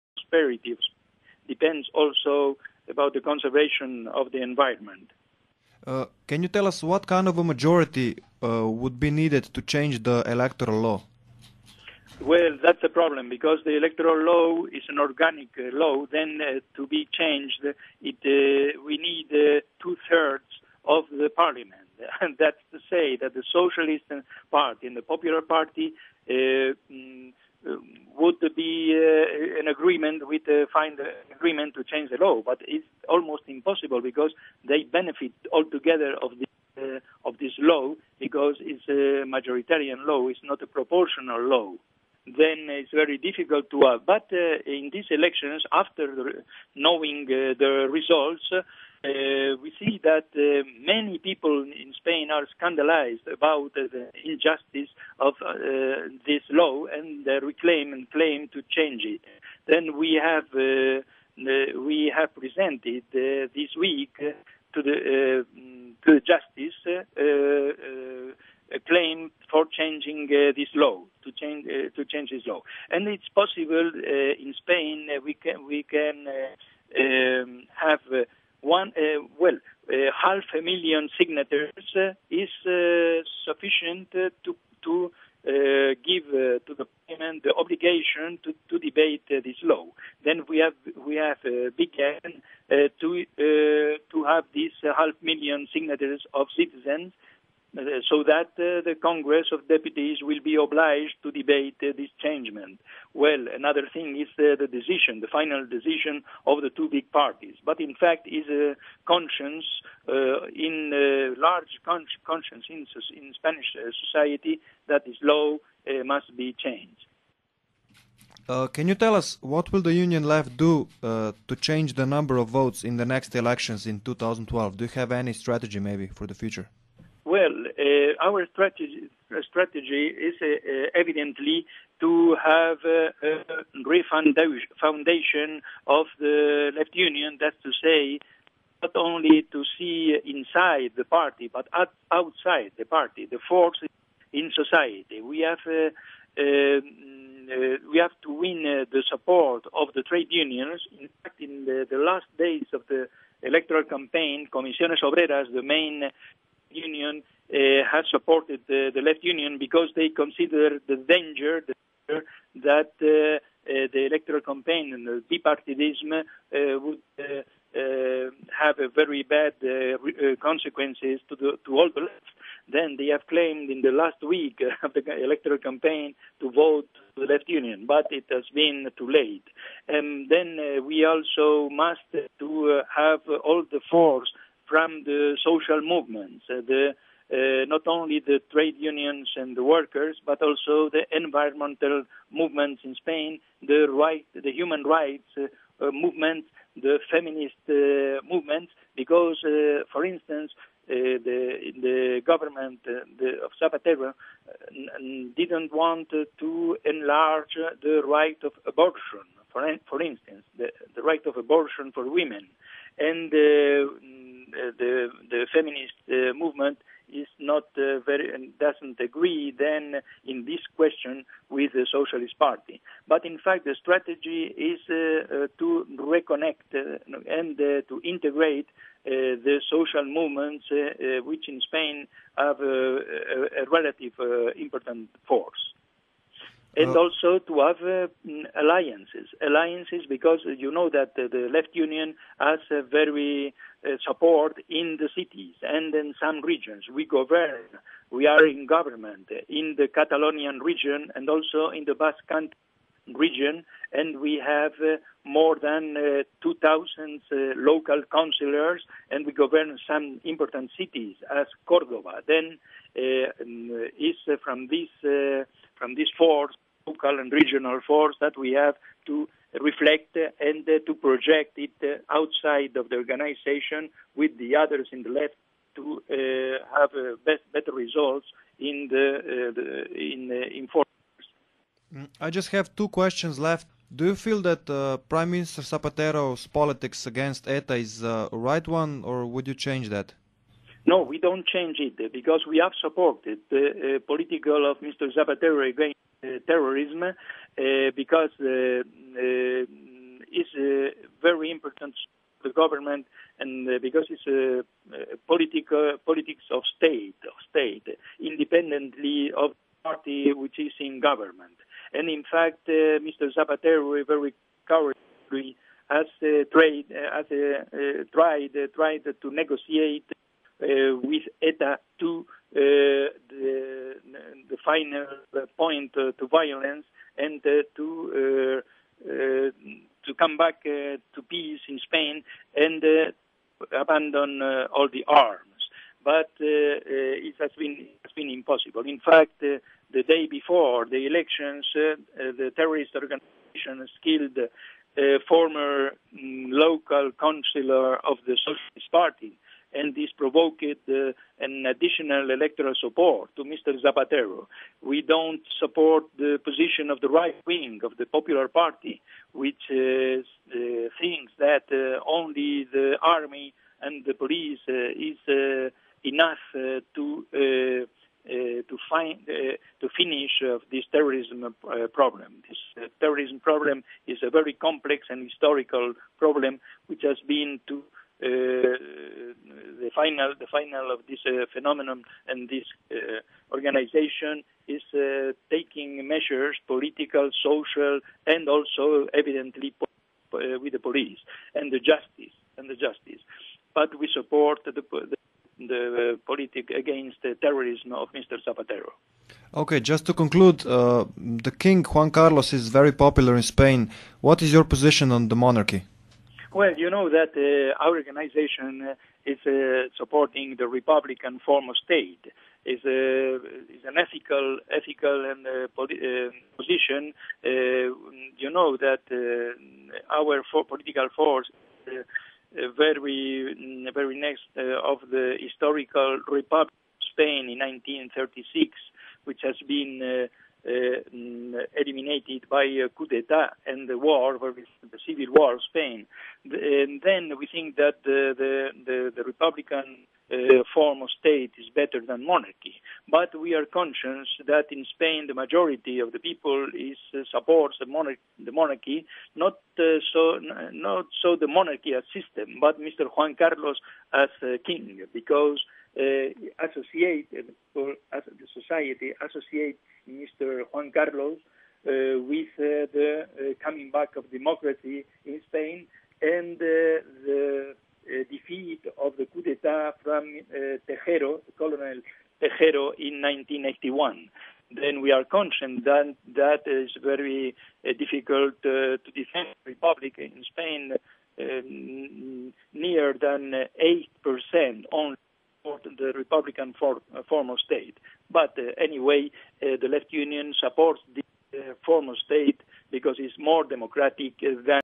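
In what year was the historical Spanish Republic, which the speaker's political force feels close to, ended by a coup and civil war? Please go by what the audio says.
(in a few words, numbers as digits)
1936.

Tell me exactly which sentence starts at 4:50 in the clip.
No, we don't change it uh, because we have supported the uh, political of Mr.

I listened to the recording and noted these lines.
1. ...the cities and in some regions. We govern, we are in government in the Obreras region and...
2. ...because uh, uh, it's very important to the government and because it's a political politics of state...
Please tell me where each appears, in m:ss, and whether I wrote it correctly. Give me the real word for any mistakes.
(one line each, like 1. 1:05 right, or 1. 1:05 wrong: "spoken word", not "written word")
1. 4:04 wrong: "Catalonian", not "Obreras"
2. 4:57 right.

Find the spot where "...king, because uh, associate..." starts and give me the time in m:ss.
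7:34.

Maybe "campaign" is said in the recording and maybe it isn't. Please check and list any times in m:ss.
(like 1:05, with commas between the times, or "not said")
2:33, 2:44, 2:55.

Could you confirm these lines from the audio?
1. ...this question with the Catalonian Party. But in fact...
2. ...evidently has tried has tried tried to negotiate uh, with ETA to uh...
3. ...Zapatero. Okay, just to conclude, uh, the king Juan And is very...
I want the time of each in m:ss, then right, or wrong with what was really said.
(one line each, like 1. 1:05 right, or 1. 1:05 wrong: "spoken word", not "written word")
1. 3:40 wrong: "Socialist", not "Catalonian"
2. 5:14 wrong: "cowardly", not "evidently"
3. 6:38 wrong: "Carlos", not "And".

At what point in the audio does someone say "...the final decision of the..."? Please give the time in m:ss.
1:45.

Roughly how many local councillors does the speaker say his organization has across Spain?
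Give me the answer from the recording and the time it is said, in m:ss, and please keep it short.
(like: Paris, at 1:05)
2,000, at 4:16.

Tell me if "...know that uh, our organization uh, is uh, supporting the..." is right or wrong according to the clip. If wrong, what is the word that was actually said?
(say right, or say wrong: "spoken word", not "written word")
right.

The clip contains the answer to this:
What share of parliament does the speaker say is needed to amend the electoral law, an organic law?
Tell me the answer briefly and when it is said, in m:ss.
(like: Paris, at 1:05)
two thirds, at 0:19.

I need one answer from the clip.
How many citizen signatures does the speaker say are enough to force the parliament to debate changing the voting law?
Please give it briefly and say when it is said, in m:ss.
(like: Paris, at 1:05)
half a million, at 1:19.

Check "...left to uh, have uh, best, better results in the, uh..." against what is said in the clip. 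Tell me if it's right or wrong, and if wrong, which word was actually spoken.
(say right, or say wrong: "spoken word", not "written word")
right.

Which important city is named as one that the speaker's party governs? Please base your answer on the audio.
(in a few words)
Cordoba.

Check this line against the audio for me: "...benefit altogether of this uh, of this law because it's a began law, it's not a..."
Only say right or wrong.
wrong.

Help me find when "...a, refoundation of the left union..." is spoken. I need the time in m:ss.
2:12.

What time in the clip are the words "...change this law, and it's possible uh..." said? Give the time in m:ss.
1:12.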